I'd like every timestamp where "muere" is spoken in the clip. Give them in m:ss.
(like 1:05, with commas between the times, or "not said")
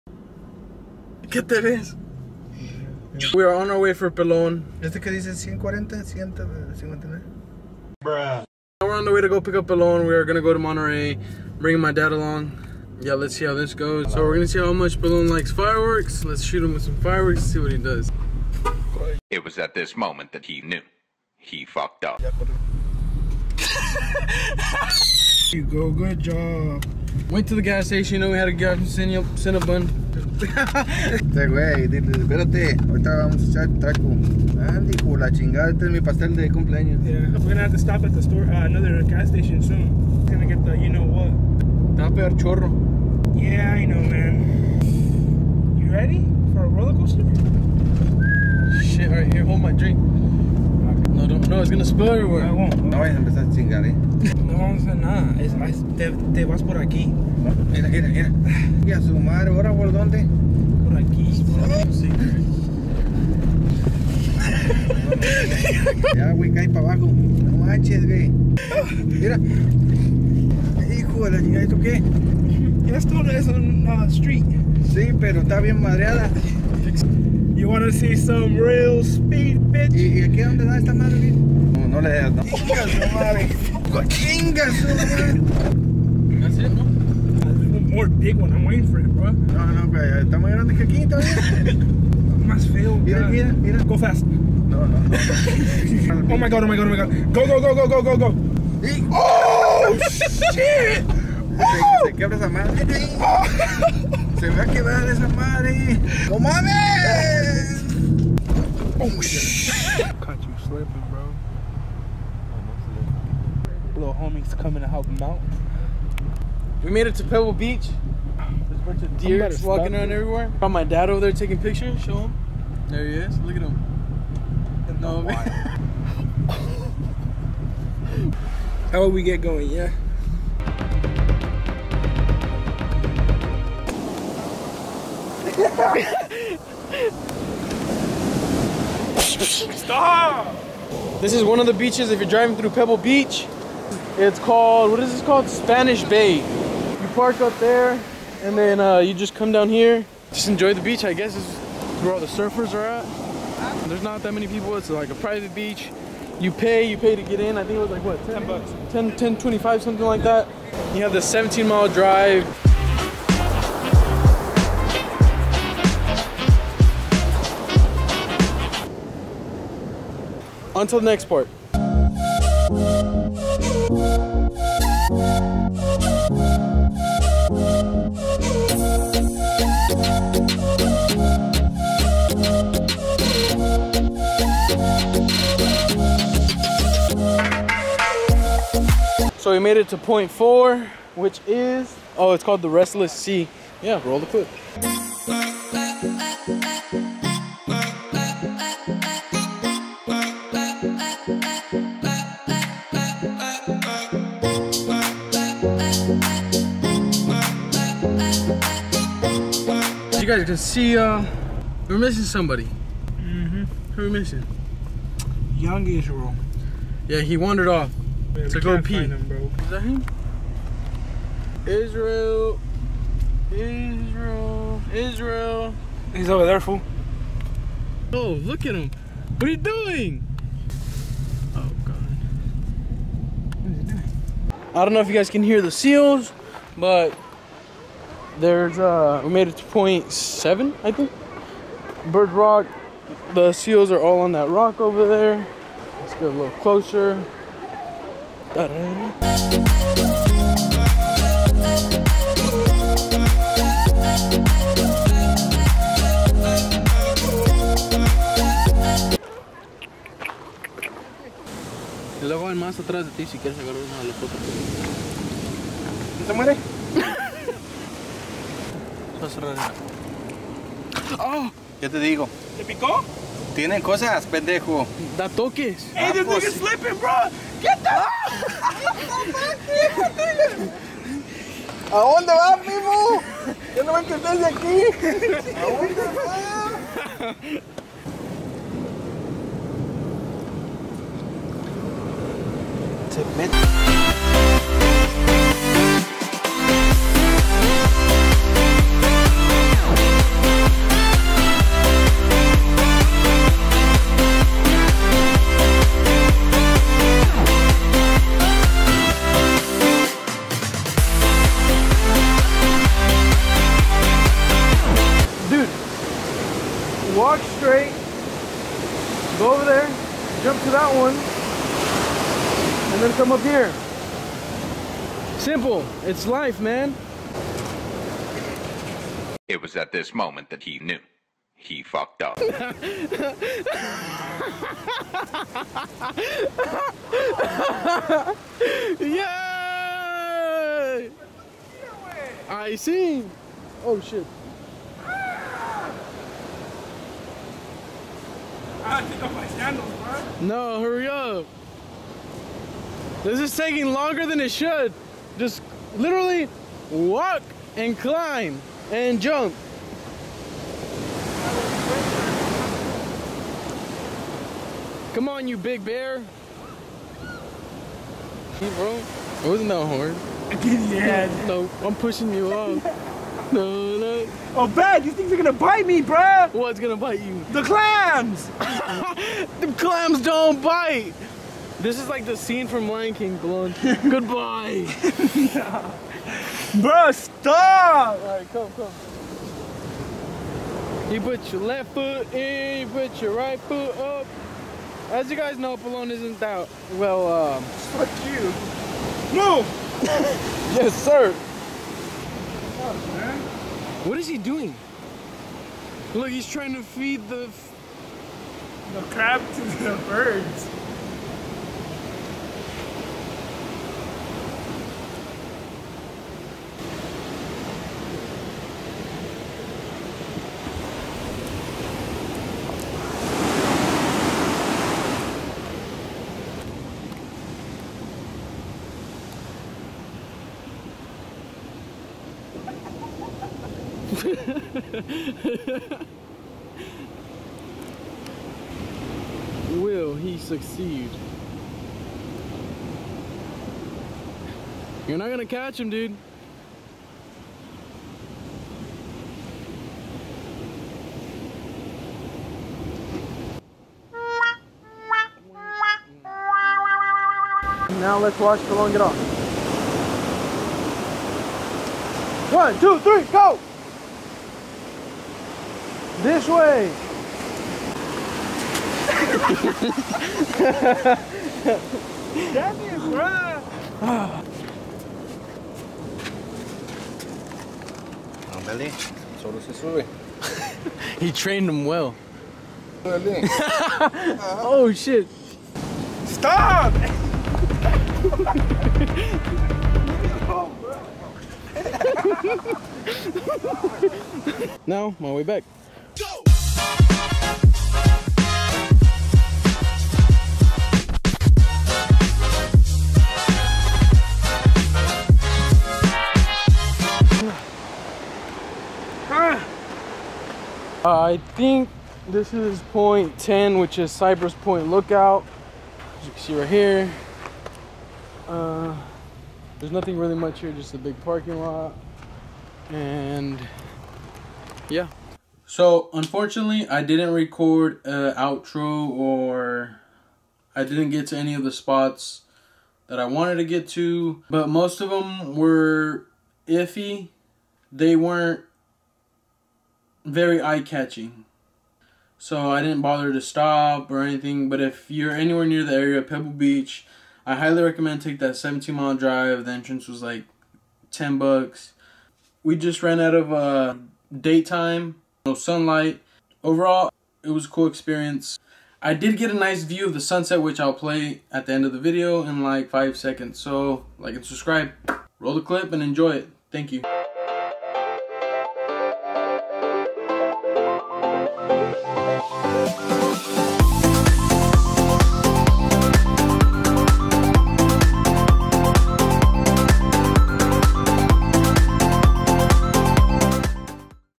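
4:29.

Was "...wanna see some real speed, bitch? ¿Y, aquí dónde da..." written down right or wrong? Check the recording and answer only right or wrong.
right.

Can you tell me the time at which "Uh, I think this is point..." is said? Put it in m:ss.
8:31.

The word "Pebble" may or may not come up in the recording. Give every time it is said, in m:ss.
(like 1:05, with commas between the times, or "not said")
1:57, 2:22, 9:06.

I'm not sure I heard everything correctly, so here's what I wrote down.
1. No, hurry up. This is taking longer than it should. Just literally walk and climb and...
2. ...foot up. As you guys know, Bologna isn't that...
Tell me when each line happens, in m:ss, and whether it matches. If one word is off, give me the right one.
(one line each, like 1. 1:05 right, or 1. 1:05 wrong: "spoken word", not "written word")
1. 5:50 right
2. 6:33 right.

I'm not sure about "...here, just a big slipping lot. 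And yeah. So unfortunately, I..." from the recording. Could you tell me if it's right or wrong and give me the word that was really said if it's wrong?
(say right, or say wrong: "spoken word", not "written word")
wrong: "parking", not "slipping".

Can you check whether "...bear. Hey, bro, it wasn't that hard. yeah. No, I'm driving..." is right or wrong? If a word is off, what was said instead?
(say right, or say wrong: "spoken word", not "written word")
wrong: "pushing", not "driving".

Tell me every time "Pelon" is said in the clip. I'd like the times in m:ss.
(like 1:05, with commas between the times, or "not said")
0:04, 0:09, 0:14.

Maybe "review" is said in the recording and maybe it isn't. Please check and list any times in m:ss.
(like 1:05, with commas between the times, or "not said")
not said.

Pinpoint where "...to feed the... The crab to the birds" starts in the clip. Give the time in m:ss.
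6:46.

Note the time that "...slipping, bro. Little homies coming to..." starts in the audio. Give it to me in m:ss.
1:50.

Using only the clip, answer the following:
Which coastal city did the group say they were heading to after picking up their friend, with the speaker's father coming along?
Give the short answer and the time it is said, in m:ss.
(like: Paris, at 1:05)
Monterey, at 0:10.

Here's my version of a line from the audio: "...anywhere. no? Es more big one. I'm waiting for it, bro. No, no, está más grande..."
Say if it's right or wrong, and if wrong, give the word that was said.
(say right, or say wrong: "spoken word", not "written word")
wrong: "madre", not "anywhere".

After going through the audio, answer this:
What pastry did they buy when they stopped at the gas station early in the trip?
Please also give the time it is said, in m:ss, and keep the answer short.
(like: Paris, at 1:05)
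Cinnabon, at 0:29.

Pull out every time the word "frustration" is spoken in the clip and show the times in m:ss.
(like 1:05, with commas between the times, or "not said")
not said.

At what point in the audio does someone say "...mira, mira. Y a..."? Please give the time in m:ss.
0:57.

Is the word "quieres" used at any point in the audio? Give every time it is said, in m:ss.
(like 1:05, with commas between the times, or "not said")
4:23.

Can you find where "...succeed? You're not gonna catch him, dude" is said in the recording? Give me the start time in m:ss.
7:20.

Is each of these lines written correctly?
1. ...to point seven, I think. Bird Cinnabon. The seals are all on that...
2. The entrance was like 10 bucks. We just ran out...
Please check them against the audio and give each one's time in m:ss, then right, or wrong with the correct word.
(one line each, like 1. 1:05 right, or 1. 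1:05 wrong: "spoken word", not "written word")
1. 3:59 wrong: "Rock", not "Cinnabon"
2. 9:09 right.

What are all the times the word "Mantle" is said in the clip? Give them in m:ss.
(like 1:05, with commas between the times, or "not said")
not said.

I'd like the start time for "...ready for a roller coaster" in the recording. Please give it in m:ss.
0:45.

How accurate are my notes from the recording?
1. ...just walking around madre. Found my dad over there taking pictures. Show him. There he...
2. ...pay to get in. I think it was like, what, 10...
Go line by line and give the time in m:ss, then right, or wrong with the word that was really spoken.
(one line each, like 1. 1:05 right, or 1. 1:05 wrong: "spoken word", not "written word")
1. 1:59 wrong: "everywhere", not "madre"
2. 2:36 right.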